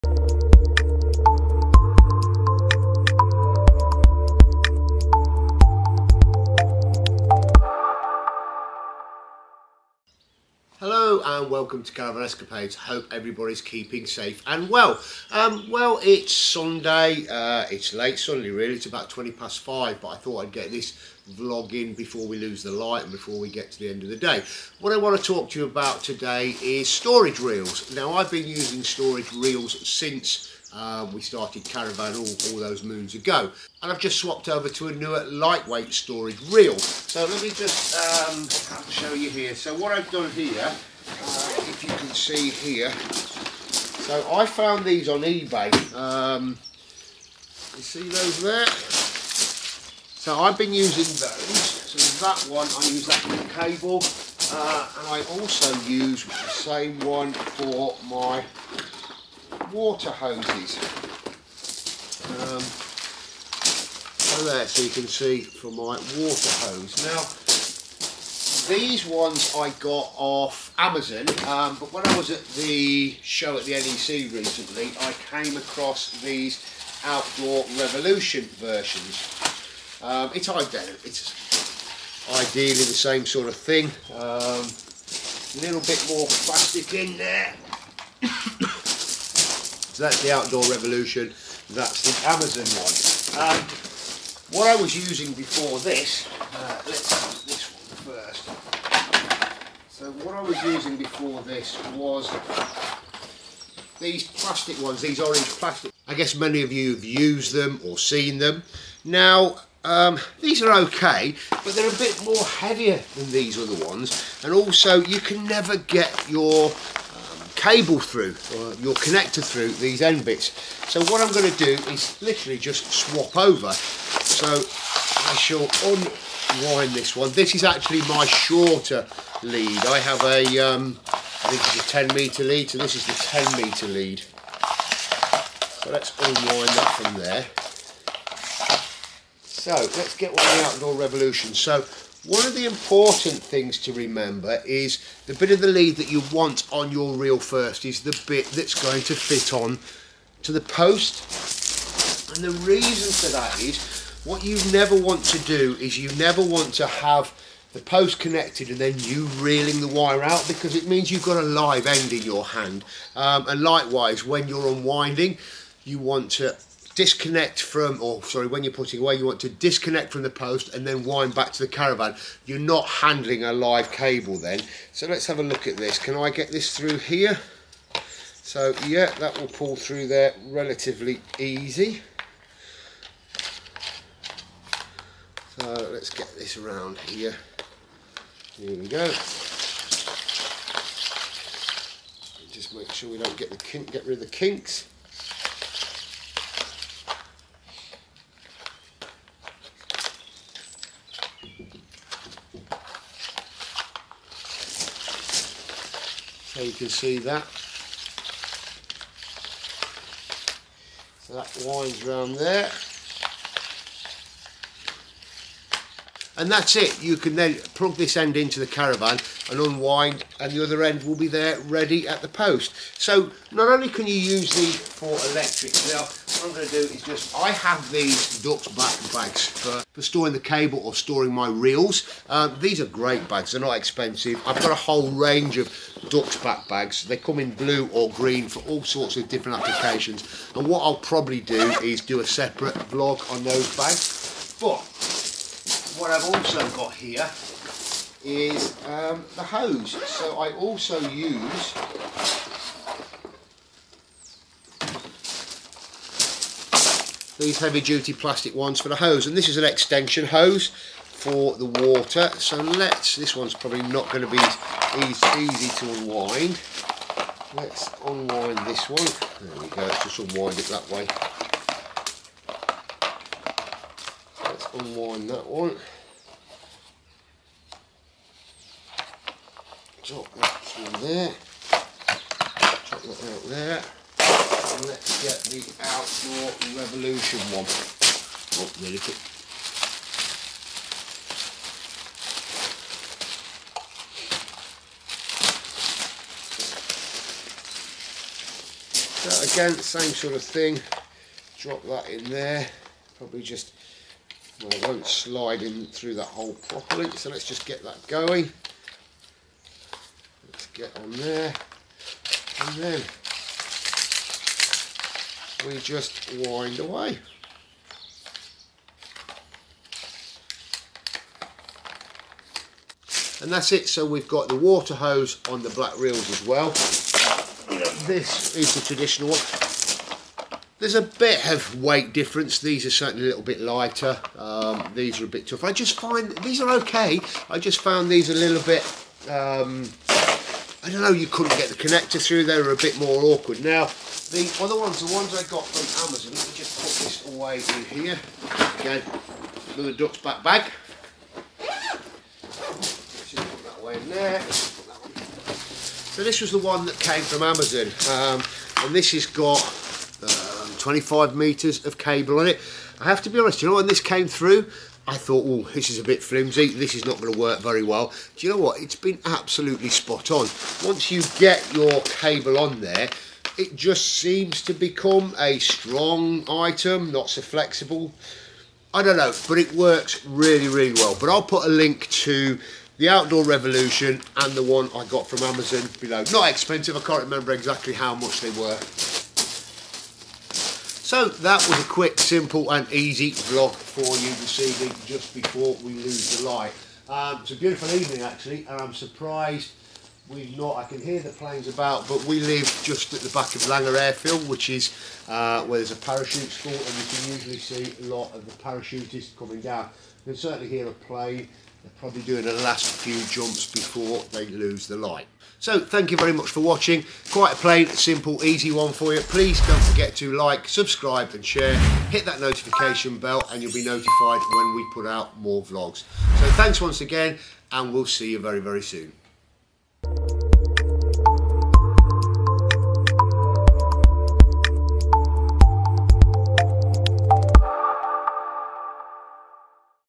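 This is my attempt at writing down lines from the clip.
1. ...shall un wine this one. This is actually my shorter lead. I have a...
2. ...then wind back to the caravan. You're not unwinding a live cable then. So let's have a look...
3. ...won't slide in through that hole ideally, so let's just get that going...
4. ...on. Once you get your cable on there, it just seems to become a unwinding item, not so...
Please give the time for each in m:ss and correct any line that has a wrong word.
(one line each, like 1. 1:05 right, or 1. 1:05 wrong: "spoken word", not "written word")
1. 2:05 right
2. 2:50 wrong: "handling", not "unwinding"
3. 5:04 wrong: "properly", not "ideally"
4. 6:10 wrong: "strong", not "unwinding".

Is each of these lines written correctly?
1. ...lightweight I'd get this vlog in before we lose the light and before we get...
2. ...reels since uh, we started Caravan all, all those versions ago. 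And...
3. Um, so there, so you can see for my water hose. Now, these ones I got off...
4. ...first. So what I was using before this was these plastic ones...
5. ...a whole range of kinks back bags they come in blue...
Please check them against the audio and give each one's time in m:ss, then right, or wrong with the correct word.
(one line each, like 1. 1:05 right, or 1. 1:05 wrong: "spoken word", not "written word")
1. 0:20 wrong: "thought", not "lightweight"
2. 0:29 wrong: "moons", not "versions"
3. 1:02 right
4. 1:38 right
5. 3:54 wrong: "ducks", not "kinks".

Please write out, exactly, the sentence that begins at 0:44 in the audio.
So I found these on eBay.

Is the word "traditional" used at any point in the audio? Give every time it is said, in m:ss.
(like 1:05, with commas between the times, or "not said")
5:28.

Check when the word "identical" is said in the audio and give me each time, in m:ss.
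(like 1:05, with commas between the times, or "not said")
1:20.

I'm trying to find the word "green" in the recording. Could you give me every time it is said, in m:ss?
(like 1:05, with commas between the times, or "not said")
3:58.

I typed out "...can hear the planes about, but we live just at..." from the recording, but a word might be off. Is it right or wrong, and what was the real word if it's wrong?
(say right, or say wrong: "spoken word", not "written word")
right.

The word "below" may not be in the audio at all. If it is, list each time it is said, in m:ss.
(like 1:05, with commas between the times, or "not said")
6:25.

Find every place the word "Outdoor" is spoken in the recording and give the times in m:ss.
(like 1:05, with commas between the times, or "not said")
1:17, 1:30, 2:20, 4:45, 6:23.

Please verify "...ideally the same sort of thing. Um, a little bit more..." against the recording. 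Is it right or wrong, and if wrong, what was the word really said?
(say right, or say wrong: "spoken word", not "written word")
right.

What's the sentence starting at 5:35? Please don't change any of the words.
I just find, these are okay.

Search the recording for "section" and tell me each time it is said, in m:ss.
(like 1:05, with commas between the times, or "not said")
not said.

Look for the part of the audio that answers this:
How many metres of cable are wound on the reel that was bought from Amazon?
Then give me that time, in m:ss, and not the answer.
6:00.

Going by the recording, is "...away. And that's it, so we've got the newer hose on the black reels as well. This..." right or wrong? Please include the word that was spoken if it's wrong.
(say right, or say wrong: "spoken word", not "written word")
wrong: "water", not "newer".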